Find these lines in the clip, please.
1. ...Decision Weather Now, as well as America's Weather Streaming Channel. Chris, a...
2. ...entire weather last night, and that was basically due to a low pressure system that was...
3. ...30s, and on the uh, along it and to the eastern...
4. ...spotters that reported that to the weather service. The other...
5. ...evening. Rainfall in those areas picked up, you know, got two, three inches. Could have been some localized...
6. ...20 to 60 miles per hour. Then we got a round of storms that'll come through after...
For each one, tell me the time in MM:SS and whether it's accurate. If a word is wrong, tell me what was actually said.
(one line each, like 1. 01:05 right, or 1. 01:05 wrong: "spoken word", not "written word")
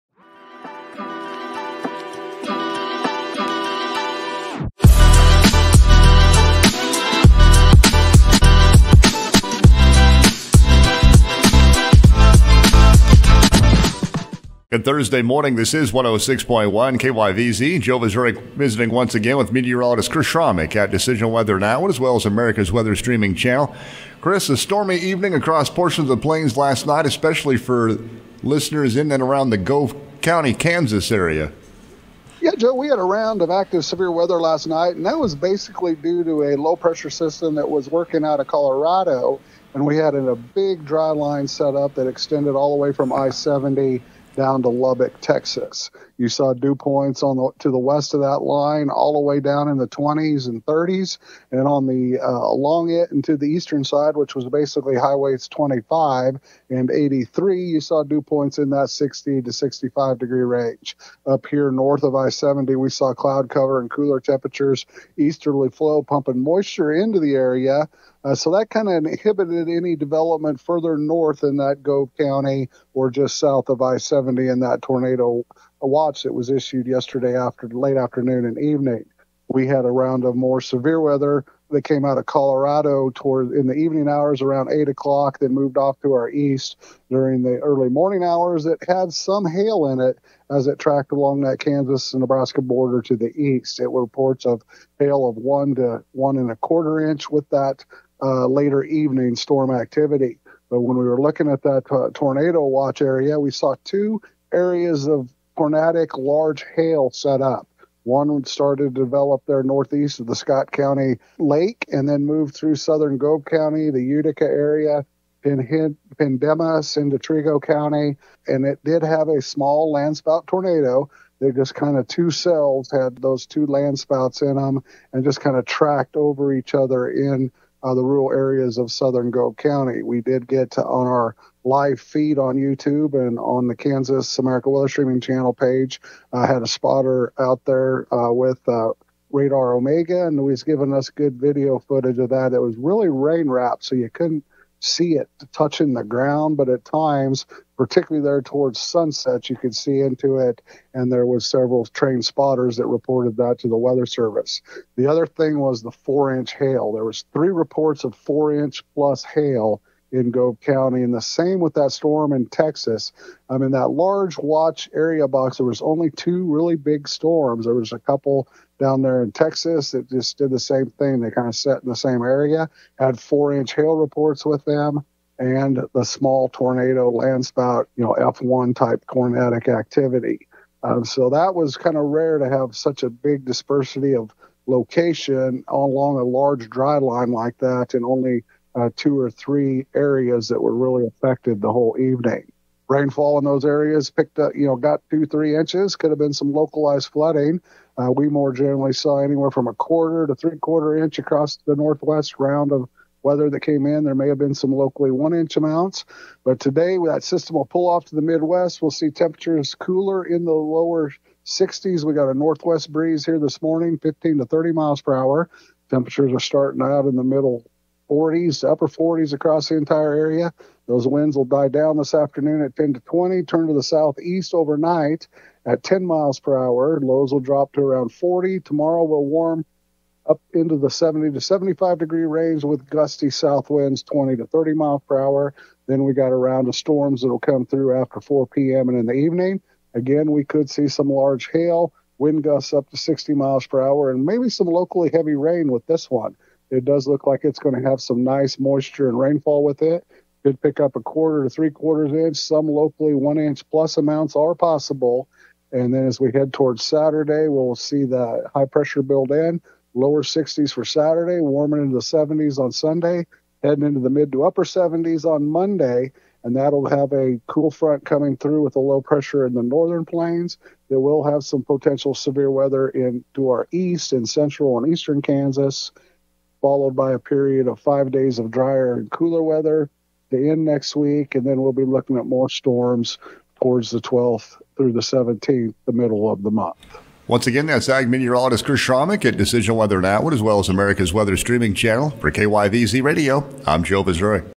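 1. 00:20 right
2. 00:33 wrong: "severe", not "entire"
3. 00:50 right
4. 02:32 right
5. 03:11 right
6. 03:54 wrong: "30", not "60".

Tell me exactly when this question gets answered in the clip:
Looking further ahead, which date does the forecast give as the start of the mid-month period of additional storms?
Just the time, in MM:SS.
04:43.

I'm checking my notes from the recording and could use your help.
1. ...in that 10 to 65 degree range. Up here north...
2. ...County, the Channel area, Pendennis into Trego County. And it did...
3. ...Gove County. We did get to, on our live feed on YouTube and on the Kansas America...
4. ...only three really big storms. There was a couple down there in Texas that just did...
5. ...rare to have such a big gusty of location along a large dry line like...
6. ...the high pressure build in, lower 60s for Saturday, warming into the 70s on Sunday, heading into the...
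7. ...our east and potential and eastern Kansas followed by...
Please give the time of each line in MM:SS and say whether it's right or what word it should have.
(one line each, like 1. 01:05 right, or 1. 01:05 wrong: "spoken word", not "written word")
1. 00:58 wrong: "60", not "10"
2. 01:53 wrong: "Utica", not "Channel"
3. 02:09 right
4. 02:45 wrong: "two", not "three"
5. 03:02 wrong: "dispersity", not "gusty"
6. 04:18 right
7. 04:33 wrong: "central", not "potential".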